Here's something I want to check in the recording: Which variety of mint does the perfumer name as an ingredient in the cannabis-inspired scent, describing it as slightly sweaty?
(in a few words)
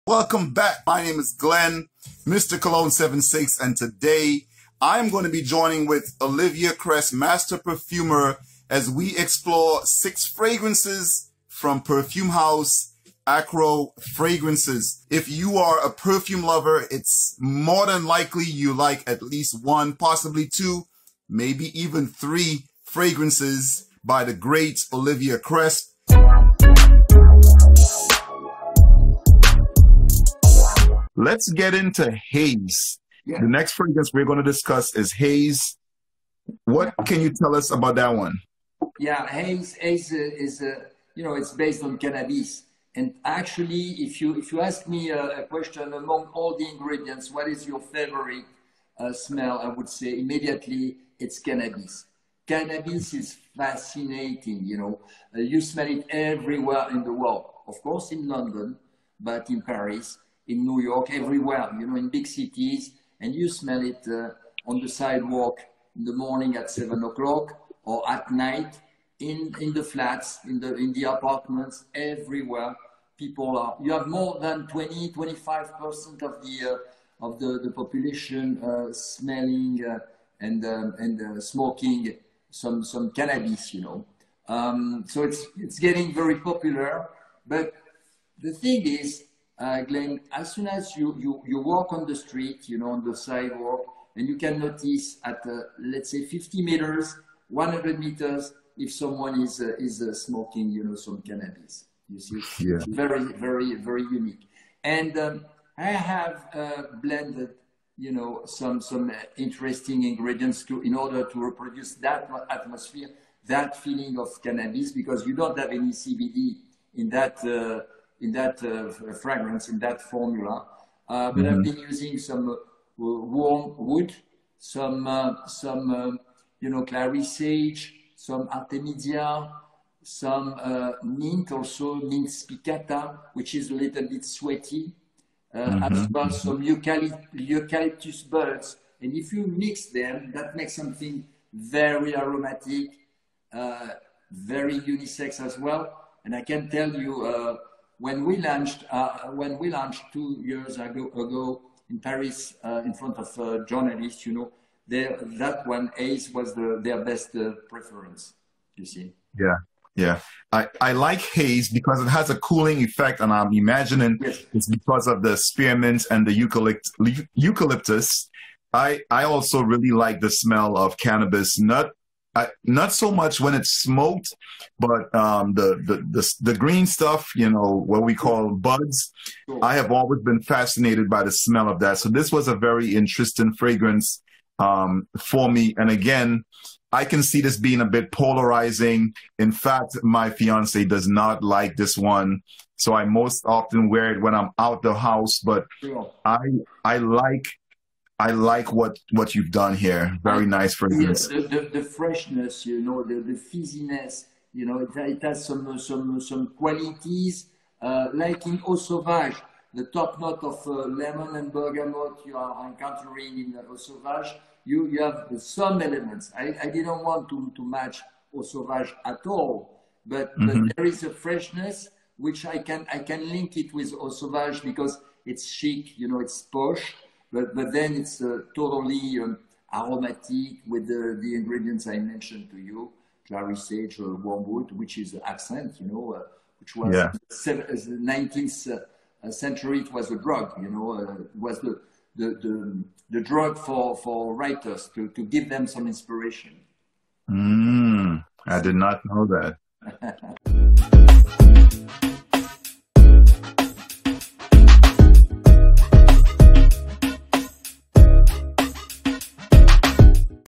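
Mint spicata.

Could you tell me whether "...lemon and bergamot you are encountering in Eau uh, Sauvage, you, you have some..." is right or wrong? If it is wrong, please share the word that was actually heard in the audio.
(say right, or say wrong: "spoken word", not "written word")
right.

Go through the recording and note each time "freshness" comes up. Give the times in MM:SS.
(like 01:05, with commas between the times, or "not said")
03:21, 03:41.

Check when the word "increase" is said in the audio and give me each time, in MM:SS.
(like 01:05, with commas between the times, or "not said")
not said.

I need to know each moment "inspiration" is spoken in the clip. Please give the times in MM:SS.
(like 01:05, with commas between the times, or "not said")
04:05.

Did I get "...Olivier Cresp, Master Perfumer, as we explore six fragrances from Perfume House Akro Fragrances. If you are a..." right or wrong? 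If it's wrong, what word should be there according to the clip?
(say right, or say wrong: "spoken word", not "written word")
right.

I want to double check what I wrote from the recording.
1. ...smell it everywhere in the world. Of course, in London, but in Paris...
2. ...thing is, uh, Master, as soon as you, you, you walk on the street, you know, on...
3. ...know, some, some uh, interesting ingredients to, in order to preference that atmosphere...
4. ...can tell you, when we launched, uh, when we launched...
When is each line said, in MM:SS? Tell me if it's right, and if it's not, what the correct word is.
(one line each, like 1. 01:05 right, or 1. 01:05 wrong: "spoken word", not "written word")
1. 00:55 right
2. 01:28 wrong: "Glenn", not "Master"
3. 01:48 wrong: "reproduce", not "preference"
4. 02:26 right.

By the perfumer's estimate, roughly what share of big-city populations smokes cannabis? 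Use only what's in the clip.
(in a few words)
20-25%.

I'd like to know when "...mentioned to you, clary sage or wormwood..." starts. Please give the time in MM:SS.
03:51.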